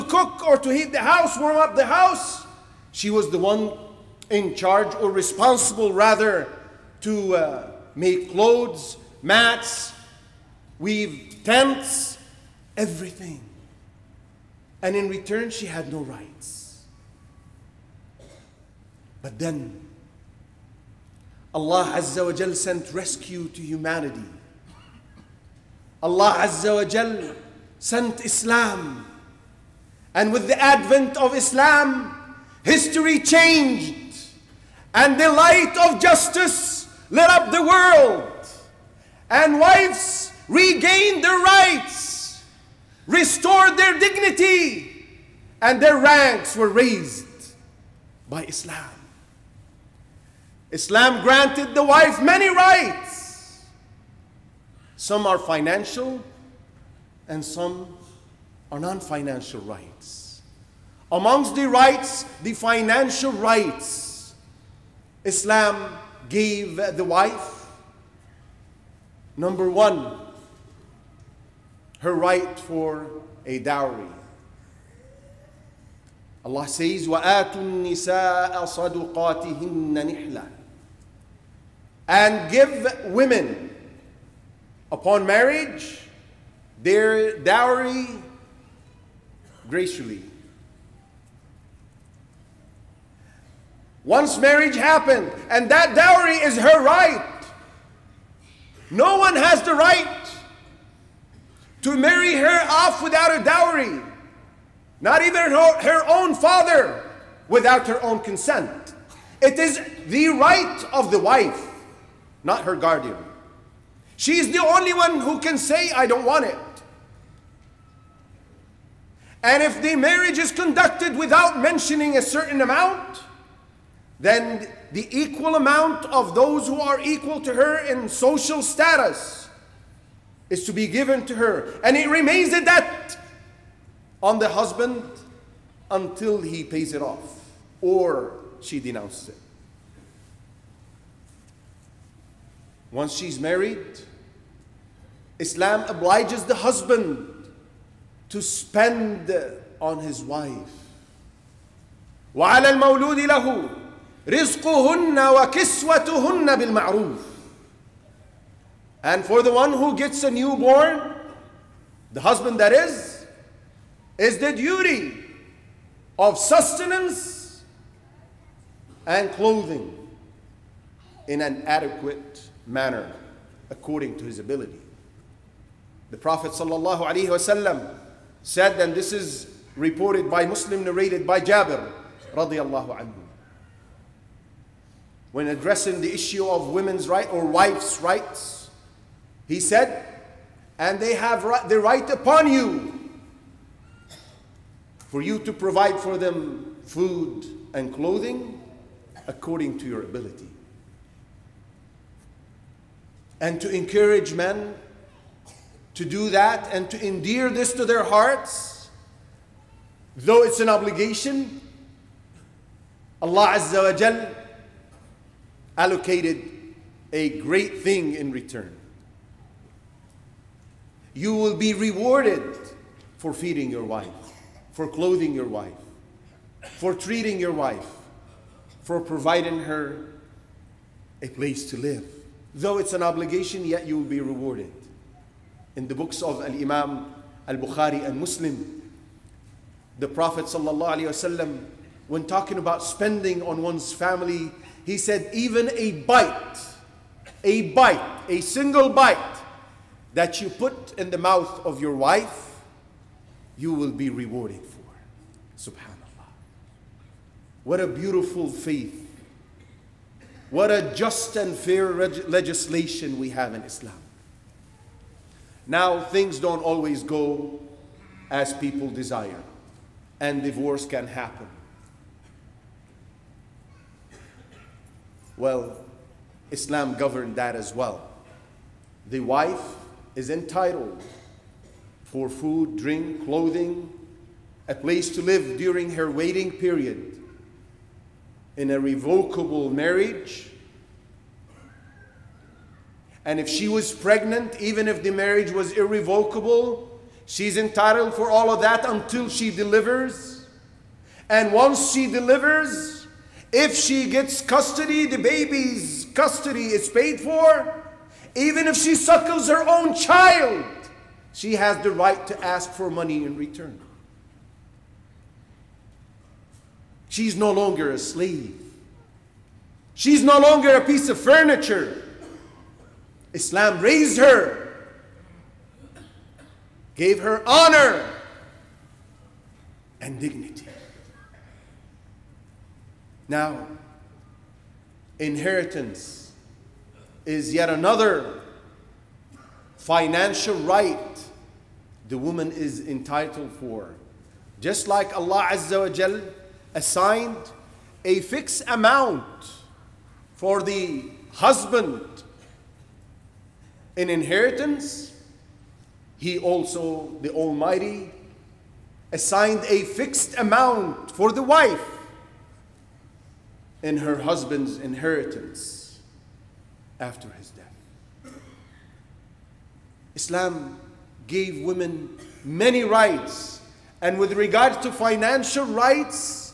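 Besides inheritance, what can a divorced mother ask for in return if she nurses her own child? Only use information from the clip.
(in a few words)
Money.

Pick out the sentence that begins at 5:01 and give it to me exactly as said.
And once she delivers, if she gets custody, the baby's custody is paid for.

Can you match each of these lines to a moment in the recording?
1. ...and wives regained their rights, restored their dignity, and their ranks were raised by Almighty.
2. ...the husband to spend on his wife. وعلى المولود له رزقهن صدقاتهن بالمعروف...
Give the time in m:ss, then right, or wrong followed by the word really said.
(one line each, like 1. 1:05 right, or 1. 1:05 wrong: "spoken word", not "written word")
1. 0:39 wrong: "Islam", not "Almighty"
2. 2:26 wrong: "وكسوتهن", not "صدقاتهن".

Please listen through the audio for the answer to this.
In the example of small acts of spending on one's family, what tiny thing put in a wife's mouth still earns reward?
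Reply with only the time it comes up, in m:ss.
4:08.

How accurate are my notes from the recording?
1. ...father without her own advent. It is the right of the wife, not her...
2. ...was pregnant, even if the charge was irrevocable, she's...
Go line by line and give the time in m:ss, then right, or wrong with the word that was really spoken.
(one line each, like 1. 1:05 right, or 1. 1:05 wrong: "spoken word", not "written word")
1. 1:46 wrong: "consent", not "advent"
2. 4:53 wrong: "marriage", not "charge".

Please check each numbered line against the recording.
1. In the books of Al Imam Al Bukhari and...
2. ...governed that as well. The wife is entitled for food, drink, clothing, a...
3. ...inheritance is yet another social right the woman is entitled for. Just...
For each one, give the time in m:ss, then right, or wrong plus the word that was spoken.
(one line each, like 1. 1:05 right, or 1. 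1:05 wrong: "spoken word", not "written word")
1. 3:55 right
2. 4:36 right
3. 5:35 wrong: "financial", not "social".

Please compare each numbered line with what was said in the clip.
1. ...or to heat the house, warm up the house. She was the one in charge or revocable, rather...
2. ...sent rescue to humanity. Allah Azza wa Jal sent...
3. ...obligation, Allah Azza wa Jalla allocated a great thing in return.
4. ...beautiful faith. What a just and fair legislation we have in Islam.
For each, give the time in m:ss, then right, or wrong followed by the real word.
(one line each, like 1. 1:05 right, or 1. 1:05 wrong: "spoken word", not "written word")
1. 0:00 wrong: "responsible", not "revocable"
2. 0:22 right
3. 3:30 right
4. 4:17 right.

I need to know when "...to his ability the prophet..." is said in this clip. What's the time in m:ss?
2:54.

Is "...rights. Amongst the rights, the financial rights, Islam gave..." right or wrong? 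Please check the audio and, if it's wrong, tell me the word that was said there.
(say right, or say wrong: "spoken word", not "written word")
right.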